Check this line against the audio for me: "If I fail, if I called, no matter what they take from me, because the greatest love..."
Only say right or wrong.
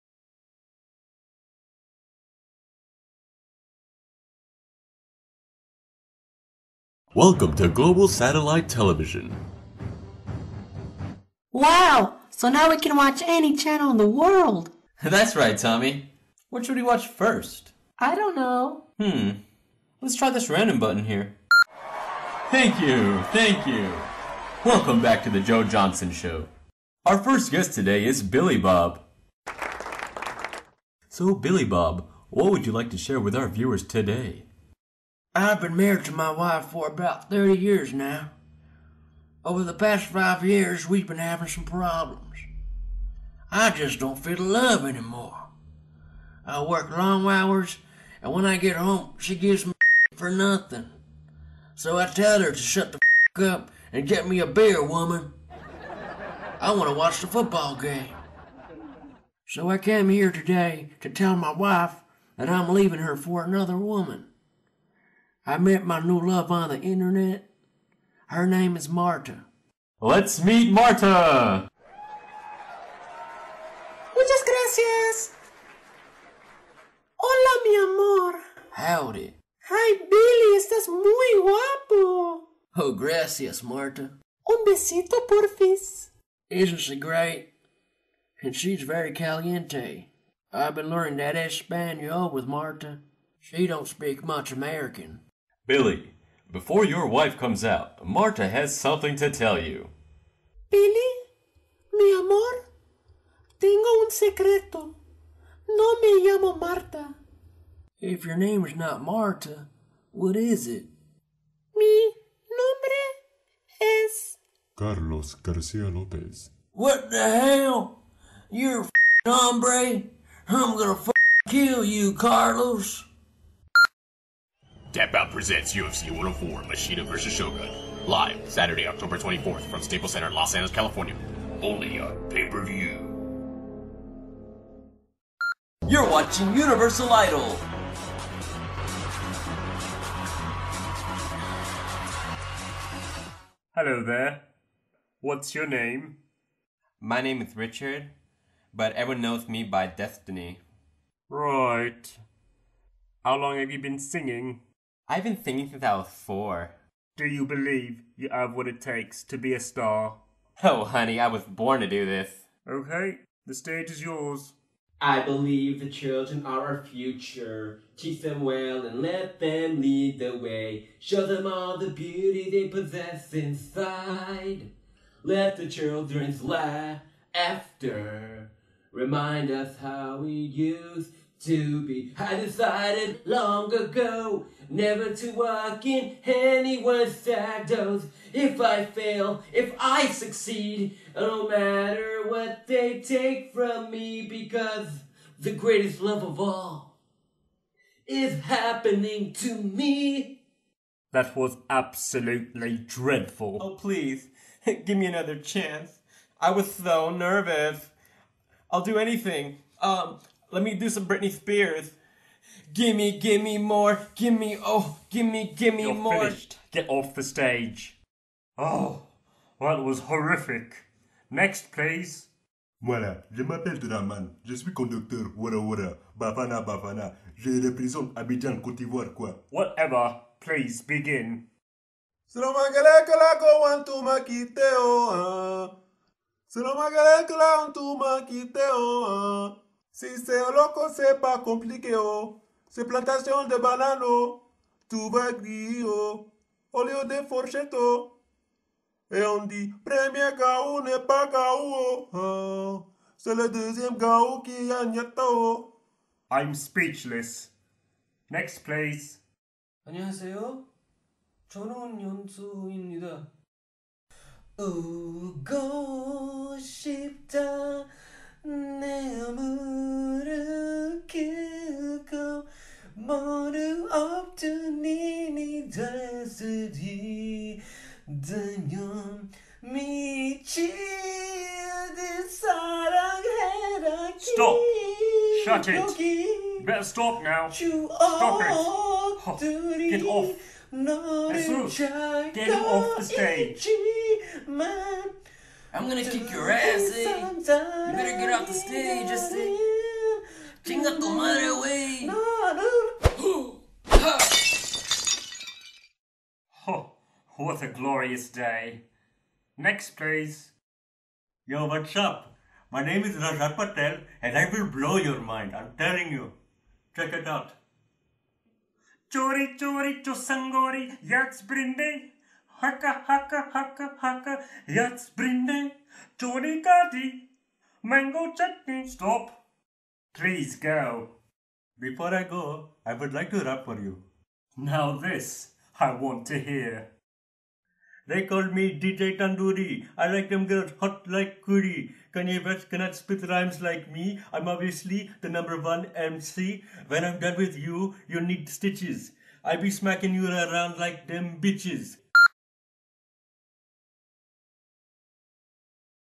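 wrong.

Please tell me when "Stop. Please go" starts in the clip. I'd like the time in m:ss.
5:28.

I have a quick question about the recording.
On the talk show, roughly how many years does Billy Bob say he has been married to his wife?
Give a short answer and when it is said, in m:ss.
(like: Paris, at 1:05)
30, at 0:37.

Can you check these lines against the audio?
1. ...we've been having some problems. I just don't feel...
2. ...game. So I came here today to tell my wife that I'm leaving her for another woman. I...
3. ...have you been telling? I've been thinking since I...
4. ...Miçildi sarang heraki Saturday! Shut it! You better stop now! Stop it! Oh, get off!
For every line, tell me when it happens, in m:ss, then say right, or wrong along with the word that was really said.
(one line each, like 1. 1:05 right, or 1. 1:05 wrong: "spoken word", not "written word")
1. 0:40 right
2. 0:57 right
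3. 2:33 wrong: "singing", not "telling"
4. 4:39 wrong: "Stop", not "Saturday".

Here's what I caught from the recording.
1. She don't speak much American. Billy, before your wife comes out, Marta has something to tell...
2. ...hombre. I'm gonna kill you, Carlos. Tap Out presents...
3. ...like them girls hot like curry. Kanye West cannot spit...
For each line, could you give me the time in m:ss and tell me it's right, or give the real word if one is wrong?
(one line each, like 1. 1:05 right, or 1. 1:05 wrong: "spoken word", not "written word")
1. 1:33 right
2. 1:59 right
3. 5:40 right.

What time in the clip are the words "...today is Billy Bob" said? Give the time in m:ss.
0:27.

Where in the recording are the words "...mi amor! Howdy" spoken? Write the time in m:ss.
1:17.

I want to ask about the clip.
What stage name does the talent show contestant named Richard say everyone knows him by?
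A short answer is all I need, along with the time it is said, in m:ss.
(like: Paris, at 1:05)
Destiny, at 2:29.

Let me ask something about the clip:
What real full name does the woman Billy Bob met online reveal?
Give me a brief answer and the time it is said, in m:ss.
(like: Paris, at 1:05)
Carlos Garcia Lopez, at 1:54.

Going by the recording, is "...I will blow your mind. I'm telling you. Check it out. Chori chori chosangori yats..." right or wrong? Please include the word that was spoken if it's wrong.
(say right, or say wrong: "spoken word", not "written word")
right.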